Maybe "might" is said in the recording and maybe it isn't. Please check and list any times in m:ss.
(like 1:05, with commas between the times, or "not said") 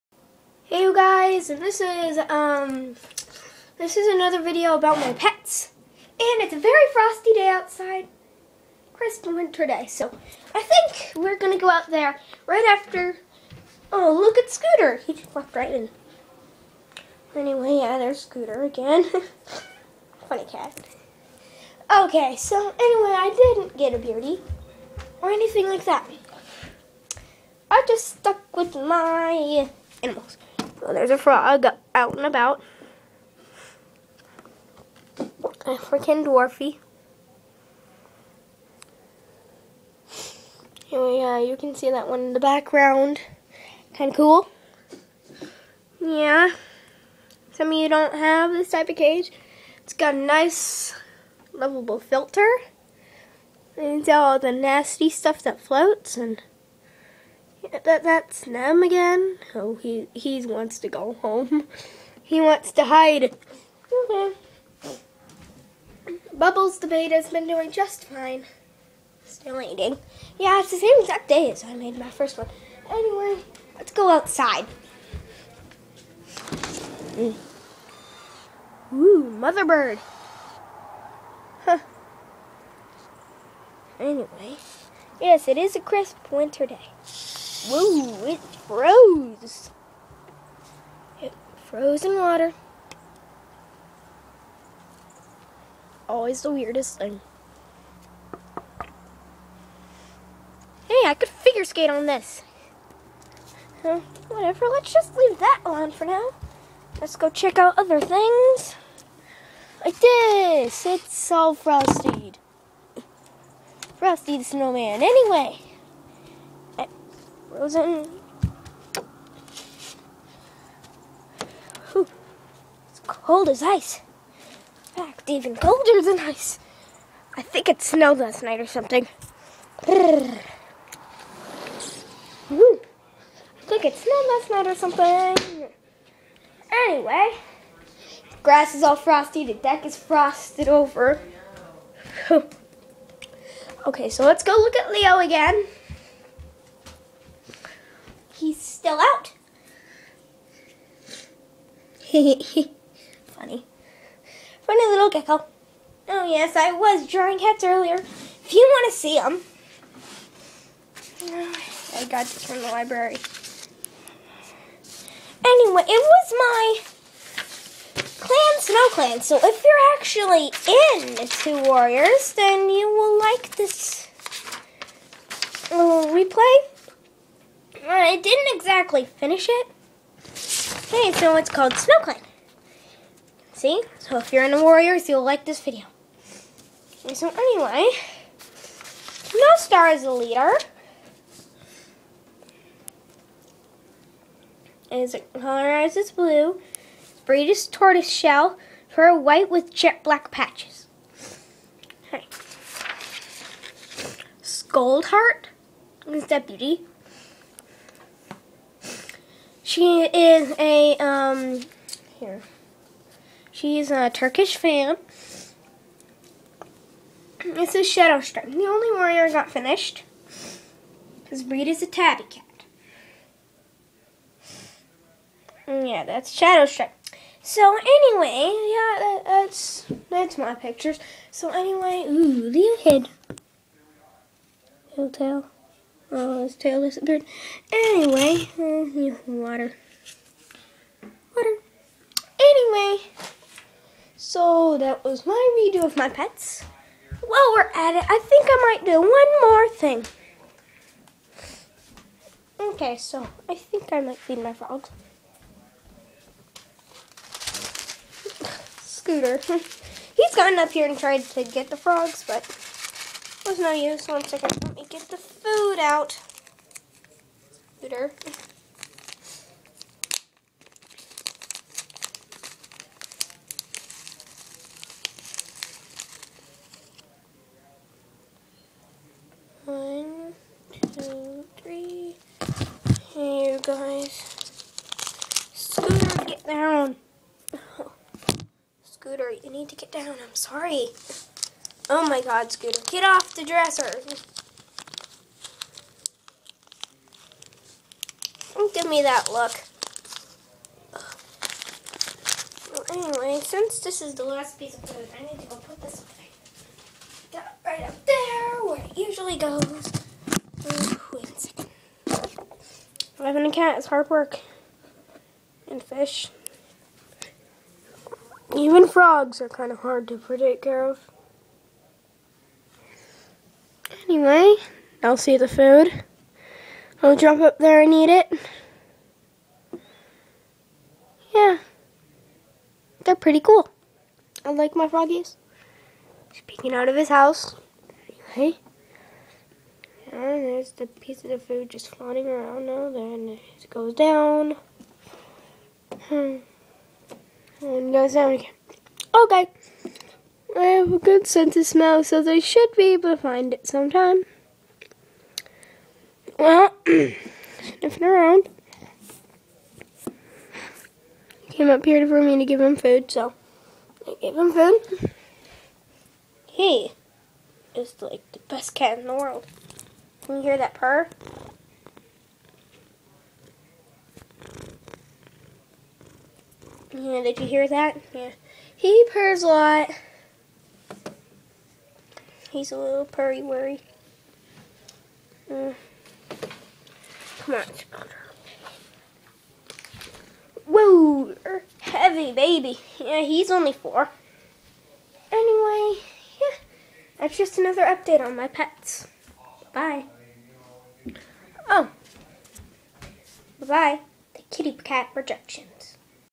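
4:08, 4:14.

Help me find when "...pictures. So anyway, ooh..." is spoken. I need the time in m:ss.
3:50.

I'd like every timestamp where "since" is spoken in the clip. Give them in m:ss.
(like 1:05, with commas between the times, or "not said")
5:03.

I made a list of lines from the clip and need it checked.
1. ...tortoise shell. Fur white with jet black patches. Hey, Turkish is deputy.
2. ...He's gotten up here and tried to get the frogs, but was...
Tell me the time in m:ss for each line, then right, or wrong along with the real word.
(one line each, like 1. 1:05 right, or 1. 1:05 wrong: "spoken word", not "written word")
1. 3:17 wrong: "Scoldheart", not "Turkish"
2. 4:20 right.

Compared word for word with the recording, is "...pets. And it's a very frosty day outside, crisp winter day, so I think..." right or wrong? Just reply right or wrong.
right.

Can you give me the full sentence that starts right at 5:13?
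Having a cat is hard work.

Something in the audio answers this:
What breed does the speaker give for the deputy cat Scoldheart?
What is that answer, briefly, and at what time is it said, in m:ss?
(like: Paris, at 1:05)
Turkish Van, at 3:34.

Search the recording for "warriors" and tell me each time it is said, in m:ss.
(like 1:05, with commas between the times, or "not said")
2:51, 3:04, 3:38.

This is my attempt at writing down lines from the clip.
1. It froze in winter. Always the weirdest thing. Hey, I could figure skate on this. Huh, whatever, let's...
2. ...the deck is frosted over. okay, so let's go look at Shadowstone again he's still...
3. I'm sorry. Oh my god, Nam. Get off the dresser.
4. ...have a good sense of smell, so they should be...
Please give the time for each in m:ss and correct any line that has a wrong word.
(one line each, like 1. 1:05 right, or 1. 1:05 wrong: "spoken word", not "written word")
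1. 1:31 wrong: "water", not "winter"
2. 2:19 wrong: "Leo", not "Shadowstone"
3. 4:50 wrong: "Scooter", not "Nam"
4. 5:50 right.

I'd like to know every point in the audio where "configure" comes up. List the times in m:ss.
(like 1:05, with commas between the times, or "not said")
not said.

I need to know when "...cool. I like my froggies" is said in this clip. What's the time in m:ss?
5:33.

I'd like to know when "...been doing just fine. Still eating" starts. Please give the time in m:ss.
1:07.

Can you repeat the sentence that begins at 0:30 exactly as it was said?
So there's a frog out and about.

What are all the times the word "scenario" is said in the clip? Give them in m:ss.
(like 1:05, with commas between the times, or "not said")
not said.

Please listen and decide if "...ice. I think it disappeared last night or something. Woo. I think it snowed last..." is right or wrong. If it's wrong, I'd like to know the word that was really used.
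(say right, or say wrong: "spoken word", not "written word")
wrong: "snowed", not "disappeared".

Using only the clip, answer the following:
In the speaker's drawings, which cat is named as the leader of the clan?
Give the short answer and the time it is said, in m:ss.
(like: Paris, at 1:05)
No Star, at 3:09.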